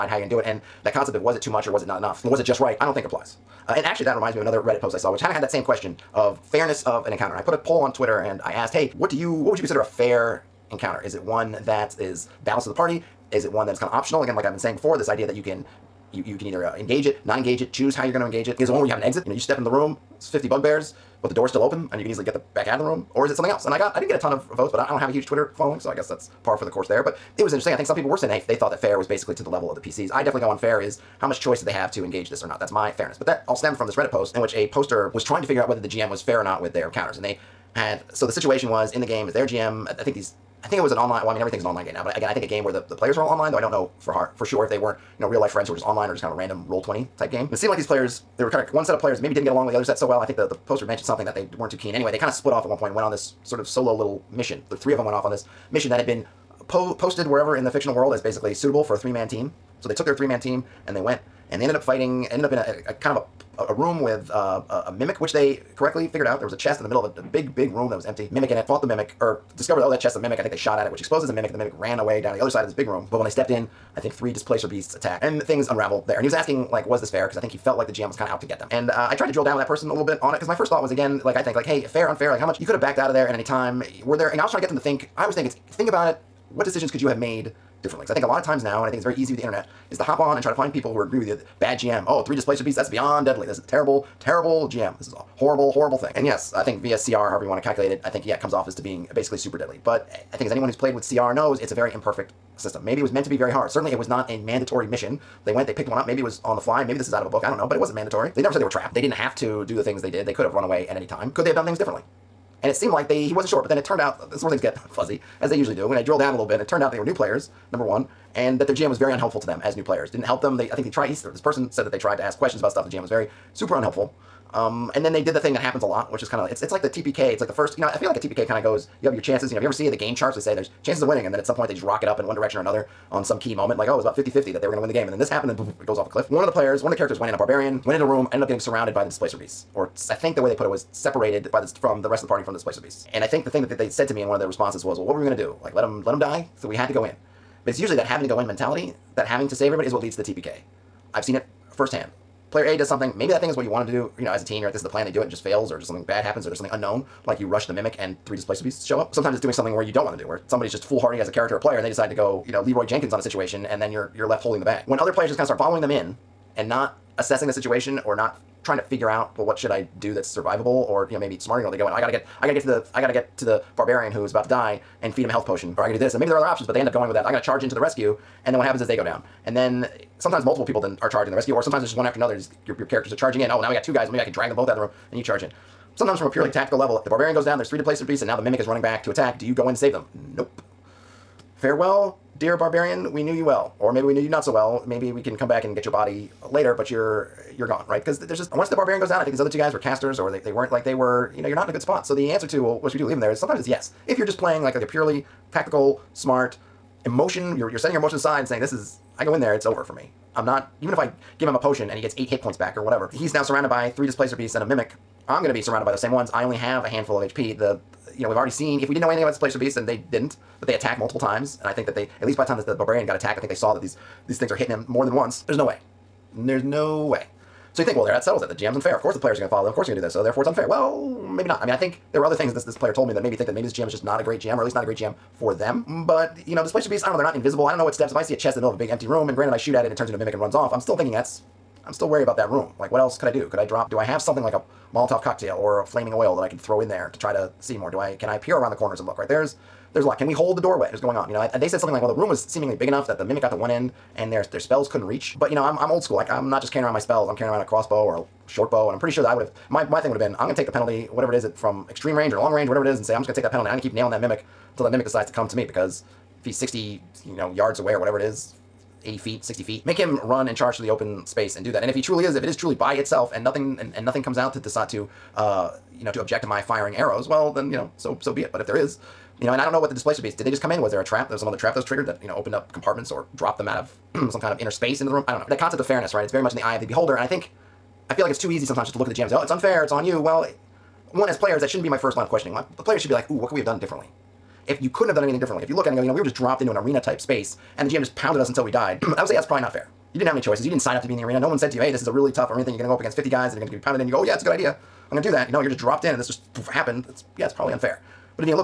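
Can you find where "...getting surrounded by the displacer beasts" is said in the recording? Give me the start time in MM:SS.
02:18.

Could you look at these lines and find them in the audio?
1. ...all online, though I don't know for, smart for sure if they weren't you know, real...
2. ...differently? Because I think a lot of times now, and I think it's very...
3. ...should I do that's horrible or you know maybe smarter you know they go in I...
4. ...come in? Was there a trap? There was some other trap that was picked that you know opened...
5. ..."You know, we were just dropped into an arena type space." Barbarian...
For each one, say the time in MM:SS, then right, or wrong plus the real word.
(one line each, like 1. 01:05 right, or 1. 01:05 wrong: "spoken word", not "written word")
1. 00:43 wrong: "heart", not "smart"
2. 01:27 right
3. 02:49 wrong: "survivable", not "horrible"
4. 04:40 wrong: "triggered", not "picked"
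5. 04:56 wrong: "And", not "Barbarian".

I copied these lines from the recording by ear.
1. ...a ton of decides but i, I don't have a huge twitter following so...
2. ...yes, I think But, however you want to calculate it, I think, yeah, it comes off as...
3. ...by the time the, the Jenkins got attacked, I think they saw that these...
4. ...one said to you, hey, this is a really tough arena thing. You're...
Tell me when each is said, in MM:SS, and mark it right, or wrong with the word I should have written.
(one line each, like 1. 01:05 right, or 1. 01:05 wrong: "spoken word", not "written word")
1. 00:24 wrong: "votes", not "decides"
2. 01:36 wrong: "VSCR", not "But"
3. 03:42 wrong: "Barbarian", not "Jenkins"
4. 05:01 right.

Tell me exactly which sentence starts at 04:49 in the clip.
It's on you." Well, one as players, that shouldn't be my first line of questioning.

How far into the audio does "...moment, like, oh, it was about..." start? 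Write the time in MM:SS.
02:13.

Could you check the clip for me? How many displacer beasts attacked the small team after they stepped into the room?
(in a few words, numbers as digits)
3.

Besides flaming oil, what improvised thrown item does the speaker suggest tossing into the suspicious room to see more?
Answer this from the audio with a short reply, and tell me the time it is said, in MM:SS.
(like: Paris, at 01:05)
Molotov cocktail, at 04:04.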